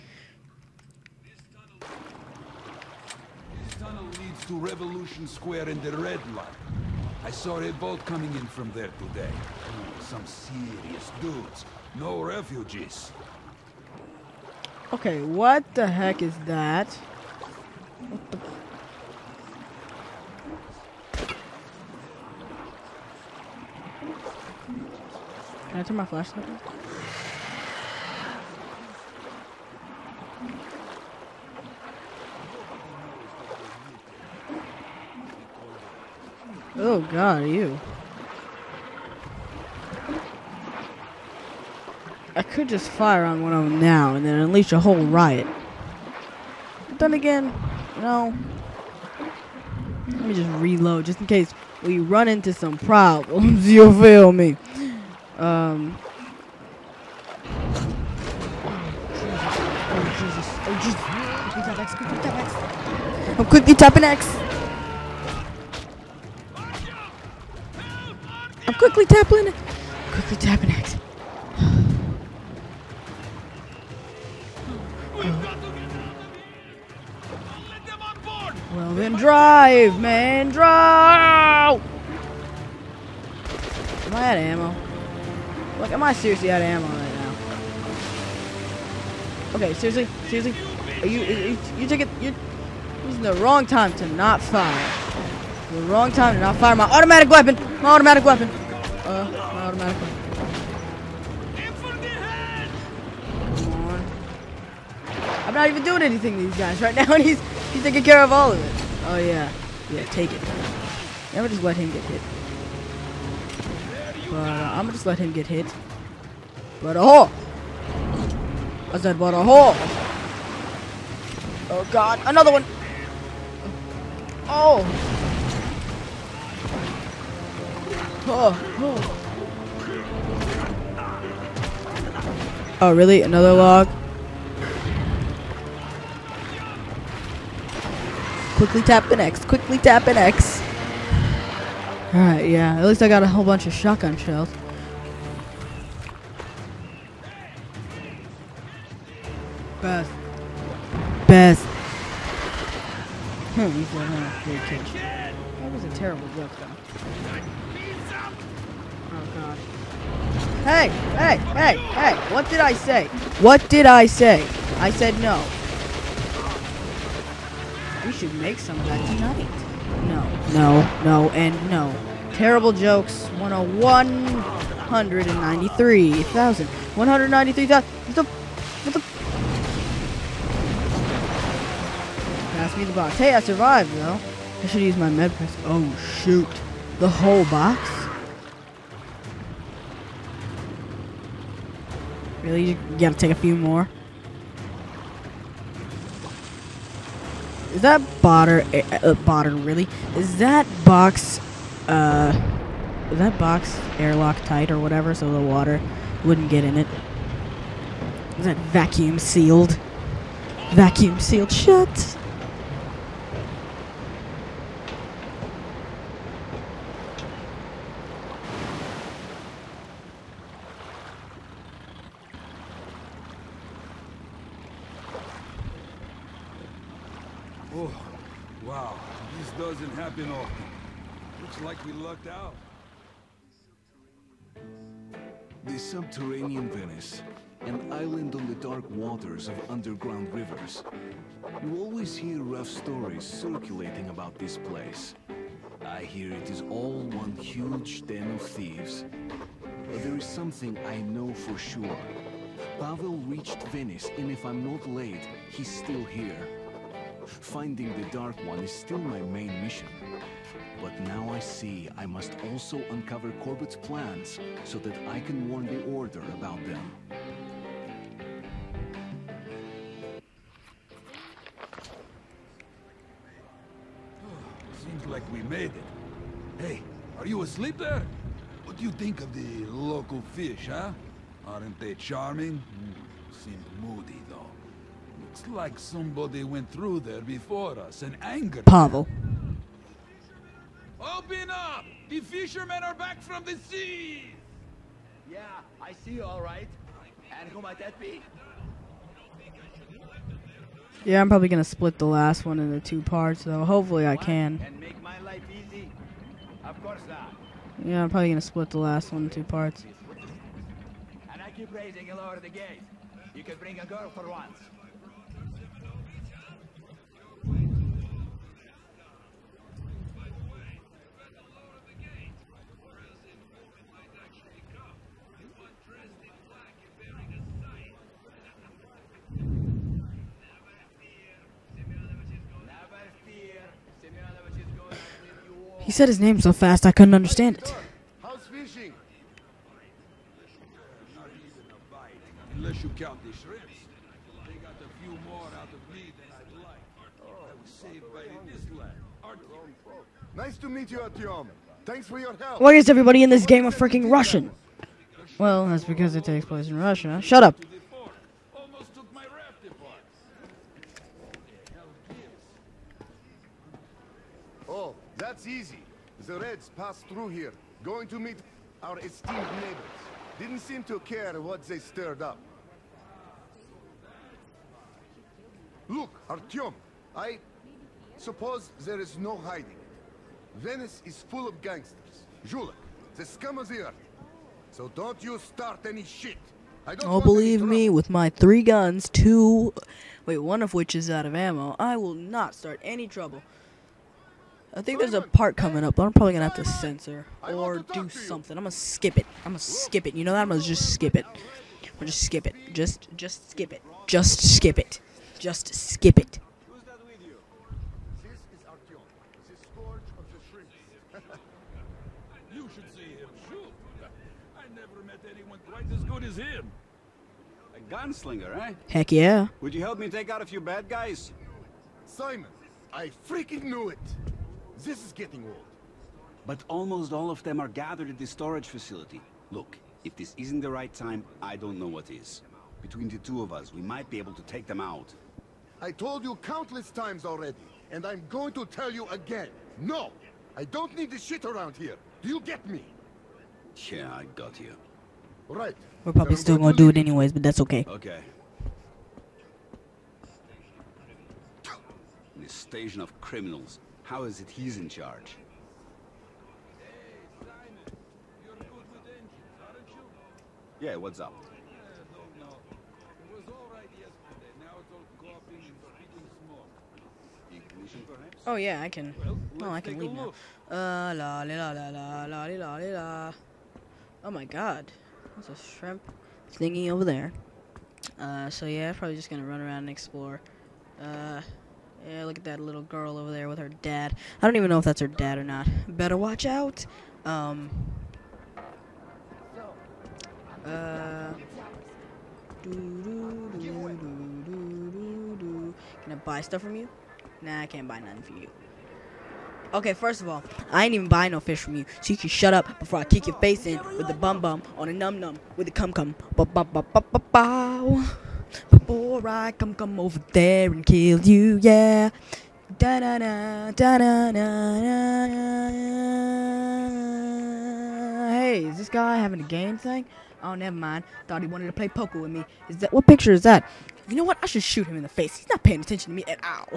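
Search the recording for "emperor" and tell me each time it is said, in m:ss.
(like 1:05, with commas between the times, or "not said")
not said.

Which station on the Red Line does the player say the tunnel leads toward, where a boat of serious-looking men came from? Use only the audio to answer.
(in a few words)
Revolution Square.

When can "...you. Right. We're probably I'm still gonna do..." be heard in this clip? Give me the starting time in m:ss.
7:24.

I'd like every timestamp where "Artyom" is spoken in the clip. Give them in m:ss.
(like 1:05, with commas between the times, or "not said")
5:51, 6:16.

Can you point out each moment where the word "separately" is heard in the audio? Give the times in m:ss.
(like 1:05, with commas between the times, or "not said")
not said.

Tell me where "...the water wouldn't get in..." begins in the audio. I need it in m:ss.
3:25.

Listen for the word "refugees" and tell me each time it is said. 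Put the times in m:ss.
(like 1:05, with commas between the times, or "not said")
0:12.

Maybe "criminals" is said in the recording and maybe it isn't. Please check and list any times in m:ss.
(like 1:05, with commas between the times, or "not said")
7:33.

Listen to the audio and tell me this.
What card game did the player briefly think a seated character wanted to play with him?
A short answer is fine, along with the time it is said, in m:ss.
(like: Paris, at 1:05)
poker, at 8:41.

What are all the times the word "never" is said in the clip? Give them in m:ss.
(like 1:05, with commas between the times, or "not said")
1:51, 6:54, 8:40.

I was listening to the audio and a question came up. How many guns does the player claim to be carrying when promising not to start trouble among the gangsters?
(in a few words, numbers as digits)
3.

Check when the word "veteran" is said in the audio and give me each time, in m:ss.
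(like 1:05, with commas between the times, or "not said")
not said.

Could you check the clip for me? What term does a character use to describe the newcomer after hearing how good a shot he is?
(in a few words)
A gunslinger.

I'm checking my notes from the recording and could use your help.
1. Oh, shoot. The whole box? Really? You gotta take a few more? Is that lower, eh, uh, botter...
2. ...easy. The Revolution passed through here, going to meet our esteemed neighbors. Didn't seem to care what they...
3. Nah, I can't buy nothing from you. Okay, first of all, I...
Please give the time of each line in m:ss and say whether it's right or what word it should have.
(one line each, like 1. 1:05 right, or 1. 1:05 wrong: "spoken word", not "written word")
1. 3:05 wrong: "botter", not "lower"
2. 6:05 wrong: "Reds", not "Revolution"
3. 8:17 right.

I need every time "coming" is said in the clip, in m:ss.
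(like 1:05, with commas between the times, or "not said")
0:08, 6:35.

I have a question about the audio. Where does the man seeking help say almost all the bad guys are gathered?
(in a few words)
the storage facility.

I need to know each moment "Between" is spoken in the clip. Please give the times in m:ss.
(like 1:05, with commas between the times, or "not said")
7:12.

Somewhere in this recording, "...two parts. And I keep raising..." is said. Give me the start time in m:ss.
5:09.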